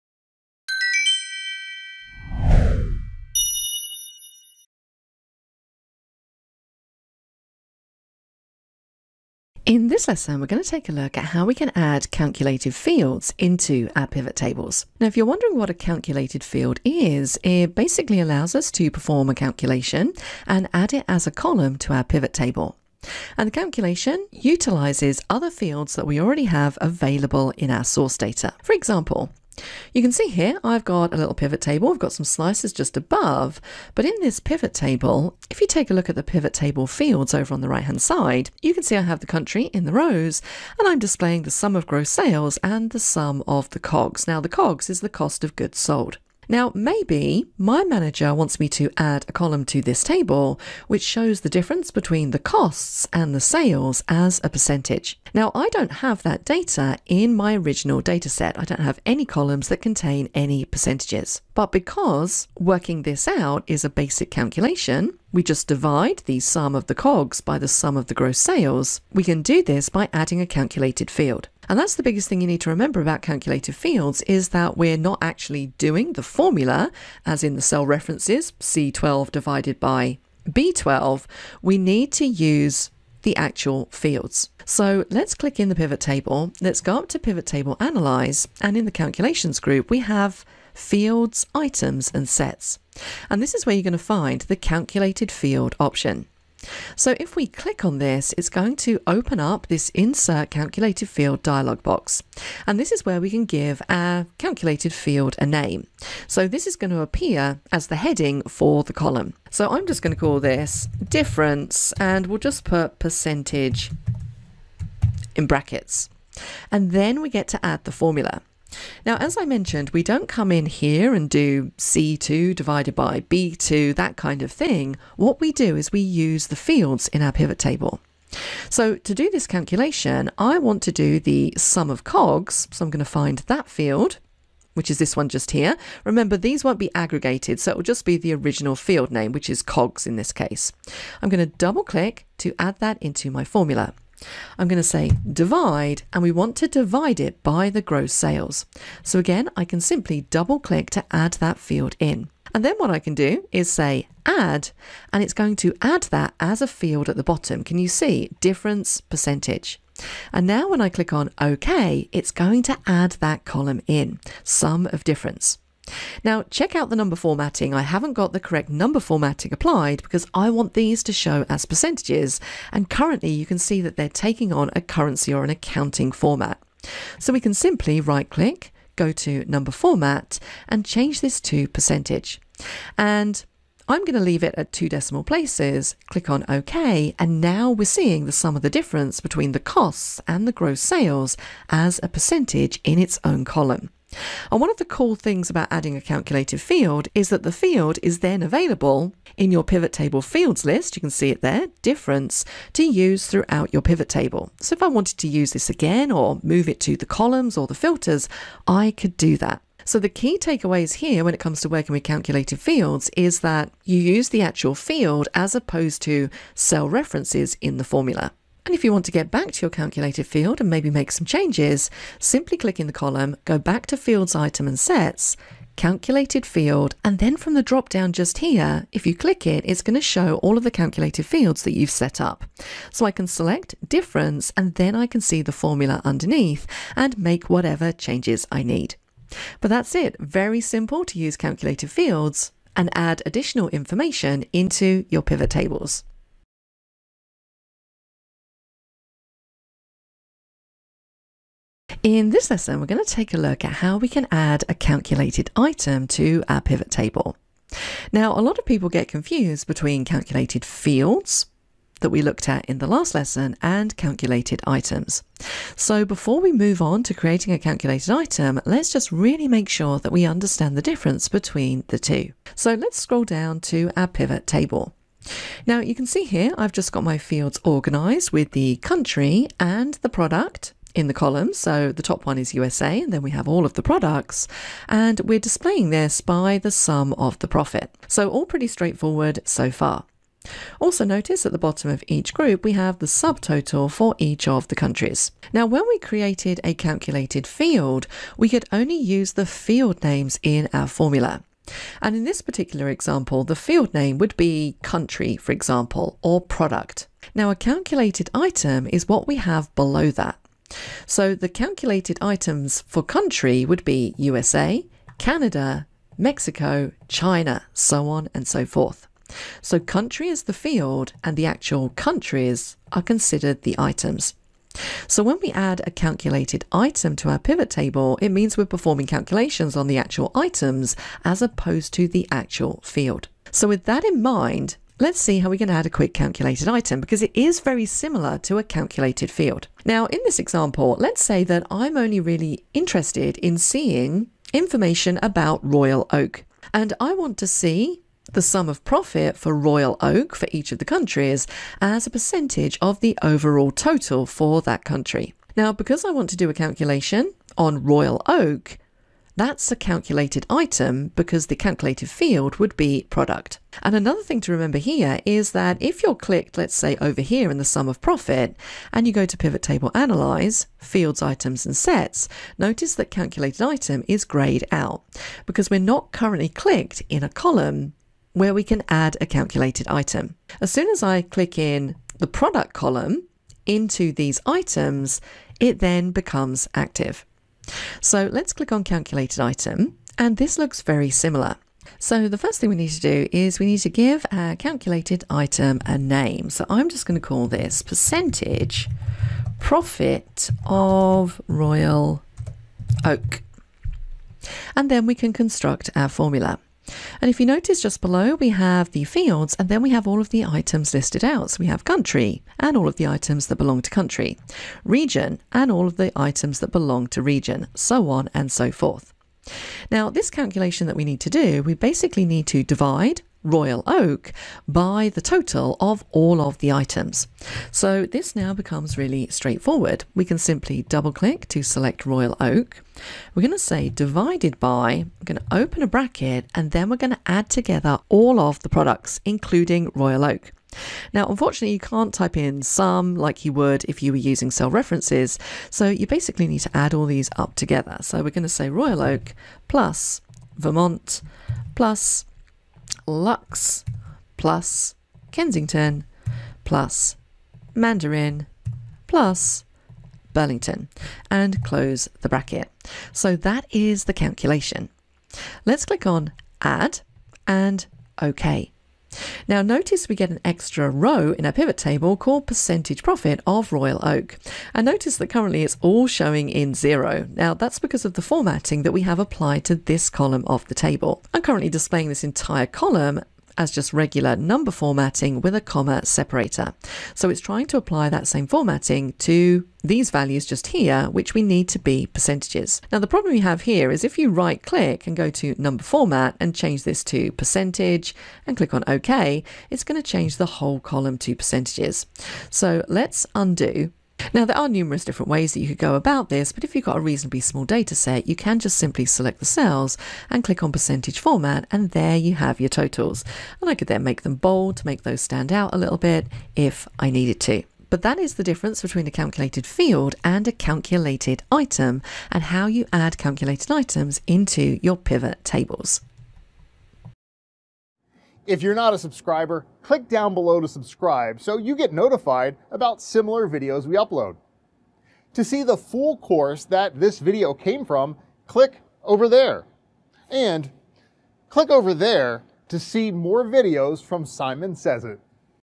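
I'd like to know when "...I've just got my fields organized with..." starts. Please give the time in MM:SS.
04:36.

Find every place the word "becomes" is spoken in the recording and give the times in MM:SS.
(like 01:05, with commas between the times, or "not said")
06:26, 07:08.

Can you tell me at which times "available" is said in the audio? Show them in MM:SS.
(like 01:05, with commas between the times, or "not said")
00:26, 03:18.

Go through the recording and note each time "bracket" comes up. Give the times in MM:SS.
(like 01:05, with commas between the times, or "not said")
01:55, 07:15, 07:42.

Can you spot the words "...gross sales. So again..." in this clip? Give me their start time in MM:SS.
02:27.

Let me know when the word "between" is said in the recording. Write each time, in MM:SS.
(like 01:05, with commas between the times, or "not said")
00:51, 03:09, 04:19, 04:31, 08:38.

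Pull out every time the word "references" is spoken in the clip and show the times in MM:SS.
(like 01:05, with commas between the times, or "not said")
01:17, 03:36, 07:24.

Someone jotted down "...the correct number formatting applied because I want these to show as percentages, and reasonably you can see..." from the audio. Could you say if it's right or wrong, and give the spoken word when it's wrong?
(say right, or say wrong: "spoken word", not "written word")
wrong: "currently", not "reasonably".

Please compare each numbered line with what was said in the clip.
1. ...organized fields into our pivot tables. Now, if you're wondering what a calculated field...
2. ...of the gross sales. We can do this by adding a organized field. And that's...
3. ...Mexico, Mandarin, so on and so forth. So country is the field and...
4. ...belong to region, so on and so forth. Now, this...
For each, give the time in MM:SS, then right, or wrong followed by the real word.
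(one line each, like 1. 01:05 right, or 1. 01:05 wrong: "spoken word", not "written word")
1. 00:12 wrong: "calculated", not "organized"
2. 01:07 wrong: "calculated", not "organized"
3. 05:16 wrong: "China", not "Mandarin"
4. 06:56 right.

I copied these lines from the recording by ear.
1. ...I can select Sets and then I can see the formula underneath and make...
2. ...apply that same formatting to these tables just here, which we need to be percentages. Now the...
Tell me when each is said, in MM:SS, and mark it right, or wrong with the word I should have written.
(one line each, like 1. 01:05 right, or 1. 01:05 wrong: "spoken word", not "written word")
1. 03:53 wrong: "Difference", not "Sets"
2. 08:07 wrong: "values", not "tables".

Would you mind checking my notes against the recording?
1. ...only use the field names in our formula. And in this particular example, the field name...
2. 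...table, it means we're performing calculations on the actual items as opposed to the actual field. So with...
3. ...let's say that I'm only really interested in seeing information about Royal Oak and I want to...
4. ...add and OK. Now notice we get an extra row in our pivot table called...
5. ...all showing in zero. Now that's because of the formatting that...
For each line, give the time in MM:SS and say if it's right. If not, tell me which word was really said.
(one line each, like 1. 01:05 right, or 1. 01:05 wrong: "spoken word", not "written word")
1. 04:58 right
2. 05:27 right
3. 05:40 right
4. 07:46 right
5. 07:55 right.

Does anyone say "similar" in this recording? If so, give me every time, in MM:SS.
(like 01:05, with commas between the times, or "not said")
05:37, 06:31, 08:53.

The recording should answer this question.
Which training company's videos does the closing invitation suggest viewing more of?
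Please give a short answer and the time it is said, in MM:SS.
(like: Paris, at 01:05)
Simon Sez IT, at 09:04.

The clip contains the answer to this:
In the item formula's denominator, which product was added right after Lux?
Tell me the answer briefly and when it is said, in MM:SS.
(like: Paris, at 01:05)
Kensington, at 07:35.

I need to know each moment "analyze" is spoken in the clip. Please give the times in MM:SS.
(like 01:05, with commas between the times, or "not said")
01:27, 06:09.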